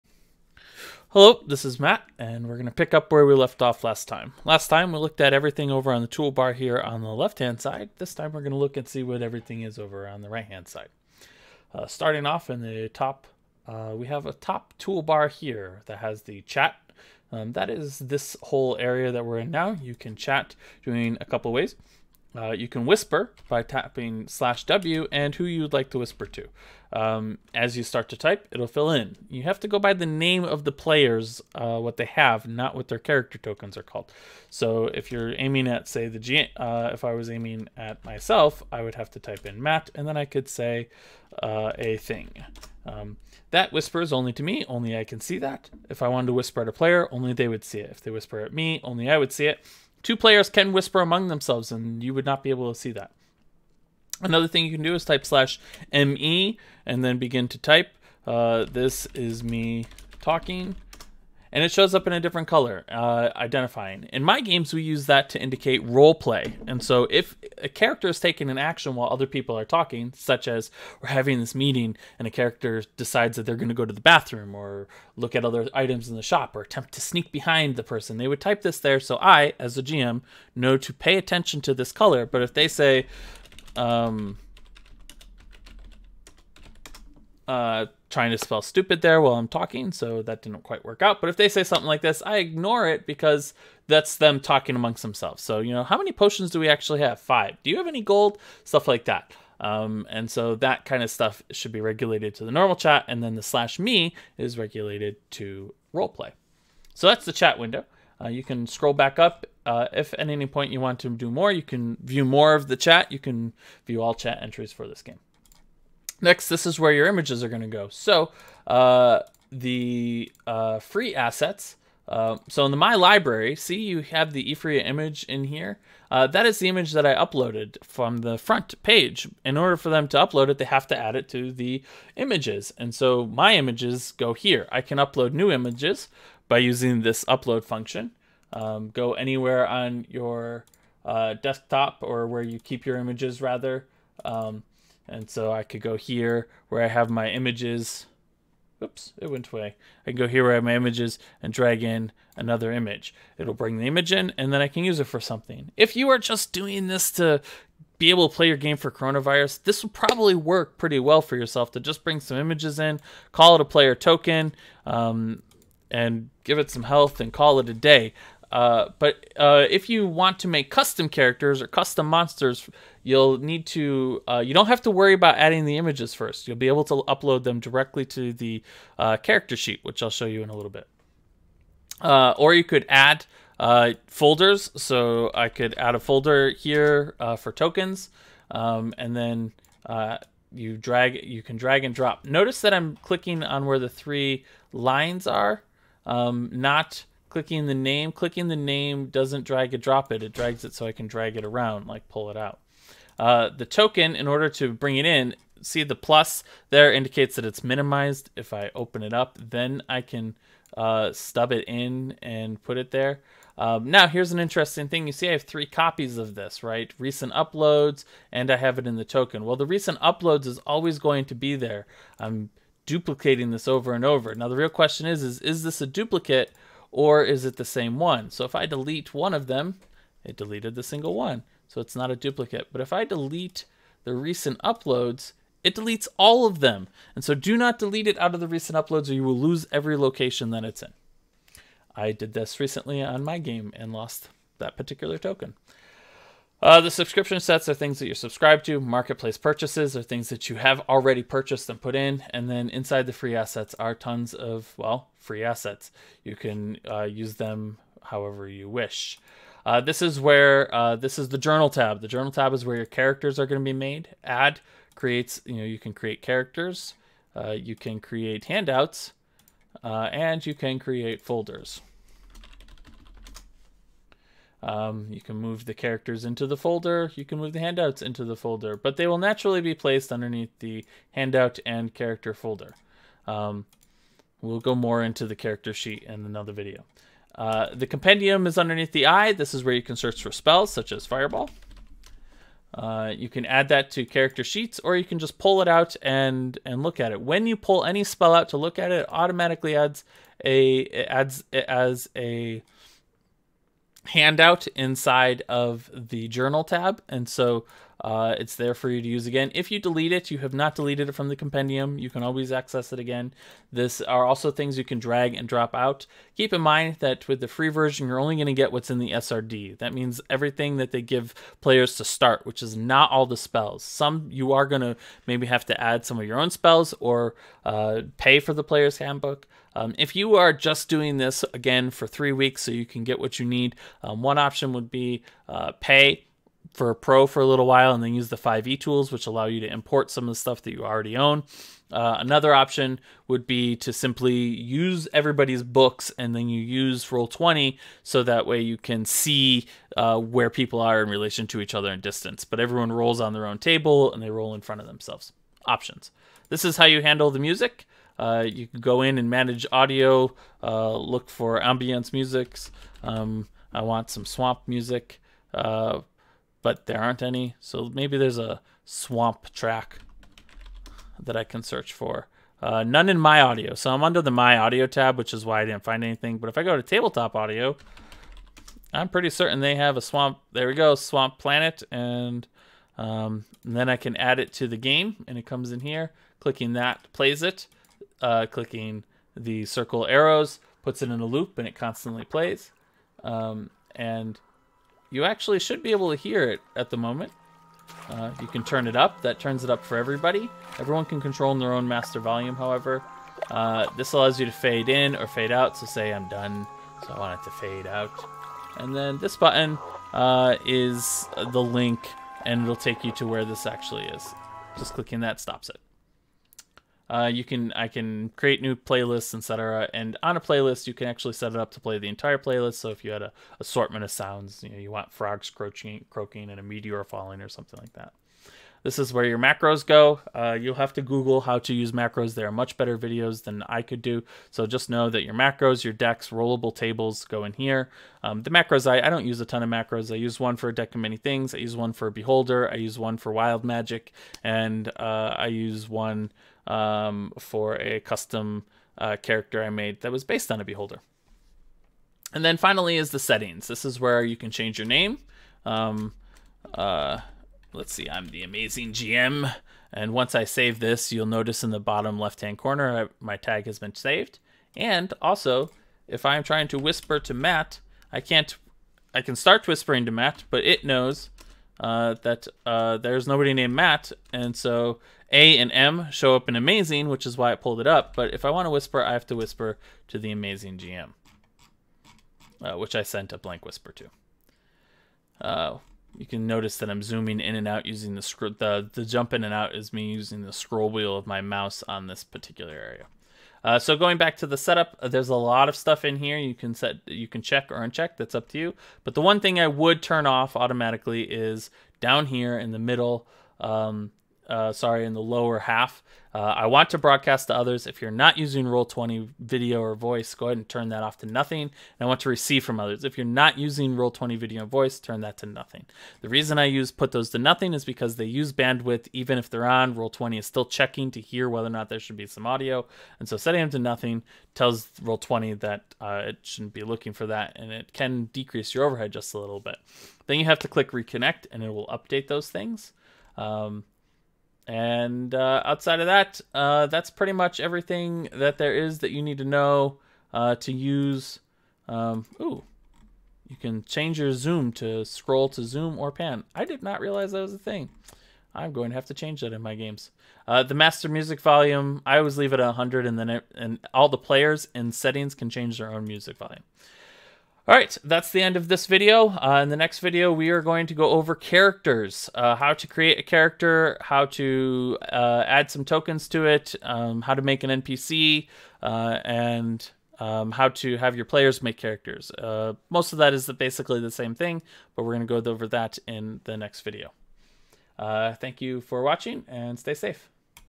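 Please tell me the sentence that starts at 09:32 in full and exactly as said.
Uh, most of that is basically the same thing, but we're going to go over that in the next video.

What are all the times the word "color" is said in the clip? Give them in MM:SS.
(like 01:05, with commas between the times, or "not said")
01:02, 01:21.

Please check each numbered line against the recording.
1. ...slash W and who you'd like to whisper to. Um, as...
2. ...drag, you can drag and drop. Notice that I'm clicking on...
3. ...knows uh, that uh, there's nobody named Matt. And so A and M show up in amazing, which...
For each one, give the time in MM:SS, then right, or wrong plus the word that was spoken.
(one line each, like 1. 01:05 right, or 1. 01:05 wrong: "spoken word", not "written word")
1. 00:24 right
2. 03:10 right
3. 07:50 right.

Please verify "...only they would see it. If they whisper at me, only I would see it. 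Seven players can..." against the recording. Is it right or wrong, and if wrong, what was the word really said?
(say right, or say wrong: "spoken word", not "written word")
wrong: "Two", not "Seven".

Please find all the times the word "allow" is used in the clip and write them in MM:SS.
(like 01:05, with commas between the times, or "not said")
05:39, 06:44.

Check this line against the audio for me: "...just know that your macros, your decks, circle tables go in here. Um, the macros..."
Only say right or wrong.
wrong.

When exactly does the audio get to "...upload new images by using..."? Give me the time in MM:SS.
02:14.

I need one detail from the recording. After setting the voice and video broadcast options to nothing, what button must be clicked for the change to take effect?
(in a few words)
reconnect.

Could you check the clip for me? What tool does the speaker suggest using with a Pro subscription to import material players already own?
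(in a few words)
5e tools.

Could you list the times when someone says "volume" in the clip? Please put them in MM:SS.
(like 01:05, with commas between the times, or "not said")
06:42, 09:11, 09:16.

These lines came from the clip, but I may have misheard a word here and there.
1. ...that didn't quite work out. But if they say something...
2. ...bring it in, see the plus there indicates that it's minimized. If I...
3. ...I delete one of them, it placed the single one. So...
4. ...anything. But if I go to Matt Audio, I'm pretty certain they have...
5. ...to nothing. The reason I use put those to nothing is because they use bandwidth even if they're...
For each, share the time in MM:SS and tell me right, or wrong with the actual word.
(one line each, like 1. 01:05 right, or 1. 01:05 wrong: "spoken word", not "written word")
1. 01:30 right
2. 03:24 right
3. 03:48 wrong: "deleted", not "placed"
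4. 06:16 wrong: "Tabletop", not "Matt"
5. 08:35 right.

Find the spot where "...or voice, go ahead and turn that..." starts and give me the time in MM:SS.
08:29.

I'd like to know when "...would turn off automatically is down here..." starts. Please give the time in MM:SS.
08:19.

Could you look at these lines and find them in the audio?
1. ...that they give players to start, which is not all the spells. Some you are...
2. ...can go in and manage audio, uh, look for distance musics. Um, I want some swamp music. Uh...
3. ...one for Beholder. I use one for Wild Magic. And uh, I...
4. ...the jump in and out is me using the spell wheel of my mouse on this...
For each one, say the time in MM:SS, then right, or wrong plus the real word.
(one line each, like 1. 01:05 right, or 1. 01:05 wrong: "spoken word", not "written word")
1. 05:20 right
2. 05:58 wrong: "ambience", not "distance"
3. 07:21 right
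4. 08:08 wrong: "scroll", not "spell".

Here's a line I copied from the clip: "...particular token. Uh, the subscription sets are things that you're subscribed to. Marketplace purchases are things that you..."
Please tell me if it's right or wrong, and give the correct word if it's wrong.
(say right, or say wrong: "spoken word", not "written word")
right.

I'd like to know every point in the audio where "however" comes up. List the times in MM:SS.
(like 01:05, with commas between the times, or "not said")
04:18, 06:42.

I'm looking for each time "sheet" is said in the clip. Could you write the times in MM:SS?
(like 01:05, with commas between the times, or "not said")
02:59, 04:45, 04:54.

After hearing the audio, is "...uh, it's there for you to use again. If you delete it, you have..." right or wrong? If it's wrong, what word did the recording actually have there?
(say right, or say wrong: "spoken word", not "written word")
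right.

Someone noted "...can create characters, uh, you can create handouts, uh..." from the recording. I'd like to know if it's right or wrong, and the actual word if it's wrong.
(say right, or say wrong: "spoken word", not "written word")
right.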